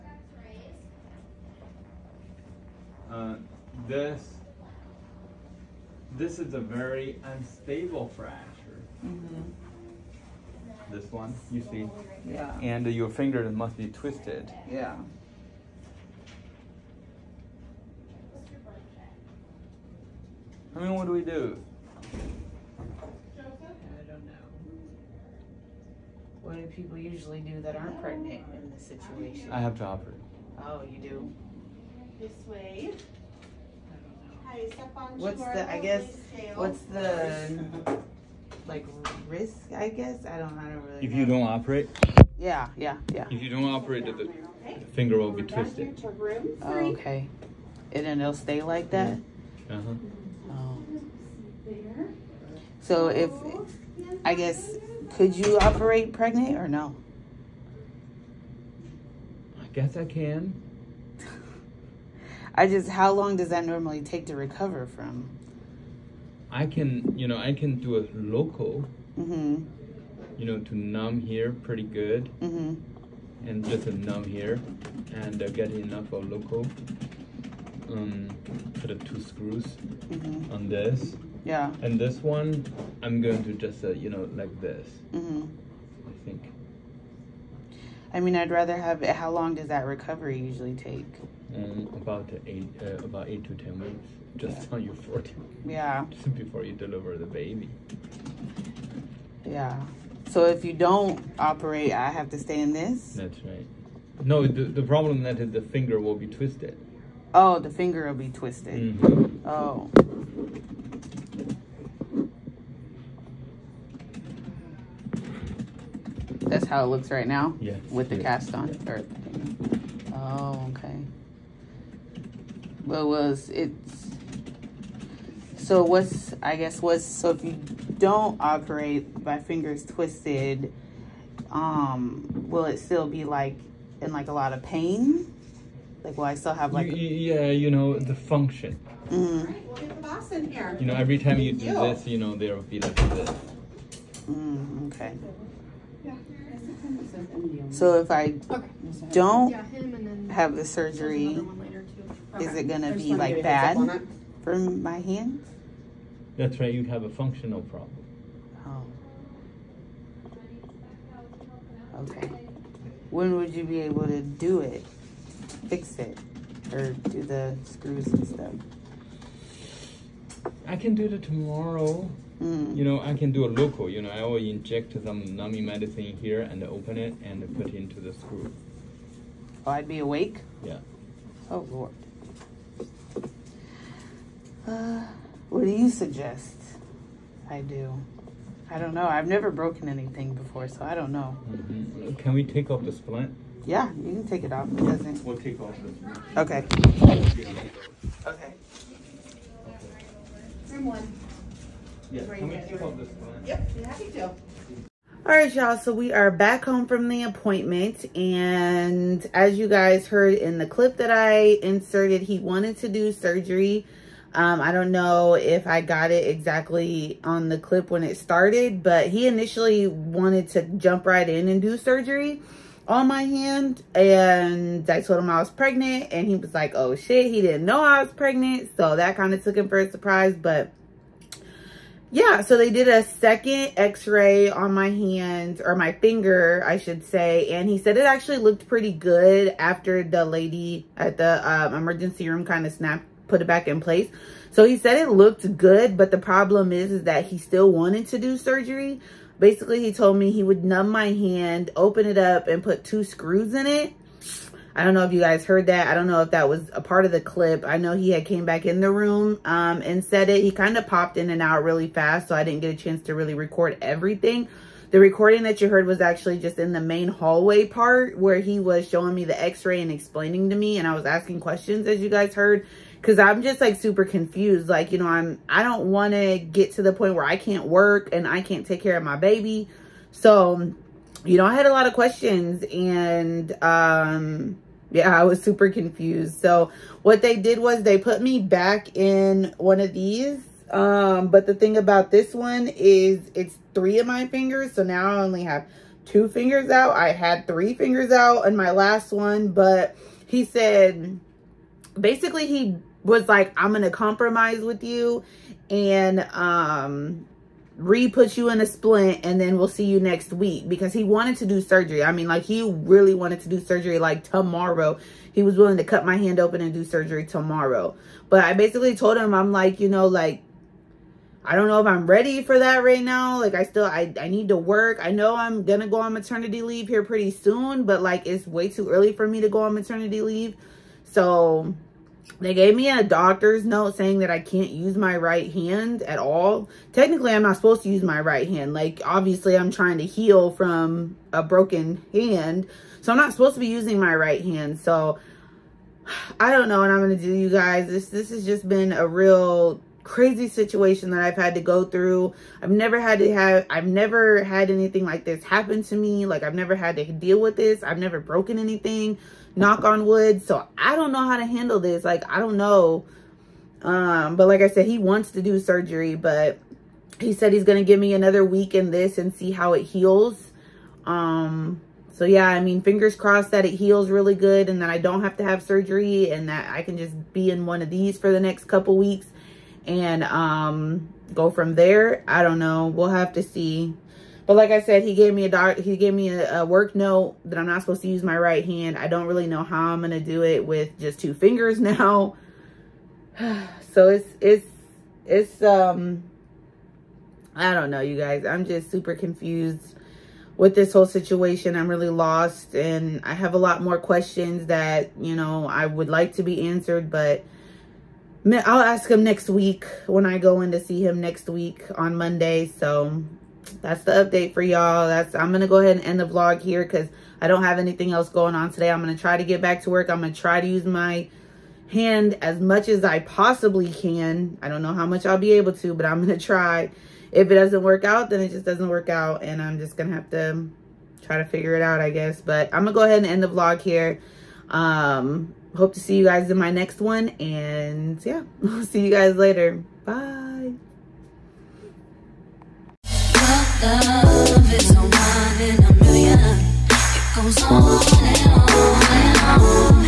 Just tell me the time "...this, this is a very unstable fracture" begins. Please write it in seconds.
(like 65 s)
3 s.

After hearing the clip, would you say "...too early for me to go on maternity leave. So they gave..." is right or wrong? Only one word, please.
right.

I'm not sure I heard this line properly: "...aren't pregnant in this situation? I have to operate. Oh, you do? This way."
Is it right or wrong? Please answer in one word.
right.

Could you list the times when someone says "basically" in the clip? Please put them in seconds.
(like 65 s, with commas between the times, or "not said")
249 s, 301 s, 318 s.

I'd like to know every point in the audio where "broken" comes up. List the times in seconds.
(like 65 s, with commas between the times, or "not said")
189 s, 341 s, 358 s.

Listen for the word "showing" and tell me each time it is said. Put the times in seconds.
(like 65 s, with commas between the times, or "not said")
268 s.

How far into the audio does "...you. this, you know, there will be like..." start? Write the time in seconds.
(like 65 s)
141 s.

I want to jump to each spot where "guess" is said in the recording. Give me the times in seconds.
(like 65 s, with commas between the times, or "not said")
35 s, 39 s, 54 s, 59 s, 126 s, 432 s.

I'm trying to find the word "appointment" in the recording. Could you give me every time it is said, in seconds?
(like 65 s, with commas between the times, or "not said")
207 s.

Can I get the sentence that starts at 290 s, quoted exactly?
Um, but the thing about this one is it's three of my fingers.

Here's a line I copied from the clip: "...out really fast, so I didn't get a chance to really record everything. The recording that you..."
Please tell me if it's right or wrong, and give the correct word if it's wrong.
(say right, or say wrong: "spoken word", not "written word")
right.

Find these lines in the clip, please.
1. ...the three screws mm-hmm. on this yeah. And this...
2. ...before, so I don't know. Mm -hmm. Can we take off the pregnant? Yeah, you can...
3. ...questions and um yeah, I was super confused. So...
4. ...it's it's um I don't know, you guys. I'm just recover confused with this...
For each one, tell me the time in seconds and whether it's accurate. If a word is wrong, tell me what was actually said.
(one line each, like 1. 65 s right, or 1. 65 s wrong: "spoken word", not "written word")
1. 78 s wrong: "two", not "three"
2. 190 s wrong: "splint", not "pregnant"
3. 281 s right
4. 394 s wrong: "super", not "recover".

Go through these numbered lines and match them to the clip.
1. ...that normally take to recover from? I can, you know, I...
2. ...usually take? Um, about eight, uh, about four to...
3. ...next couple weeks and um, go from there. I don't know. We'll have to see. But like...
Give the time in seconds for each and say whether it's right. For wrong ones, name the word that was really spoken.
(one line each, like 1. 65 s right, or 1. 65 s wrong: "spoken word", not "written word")
1. 63 s right
2. 90 s wrong: "eight", not "four"
3. 378 s right.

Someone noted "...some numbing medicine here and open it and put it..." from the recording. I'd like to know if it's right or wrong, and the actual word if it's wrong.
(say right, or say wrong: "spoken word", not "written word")
right.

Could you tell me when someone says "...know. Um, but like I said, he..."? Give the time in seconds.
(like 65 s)
362 s.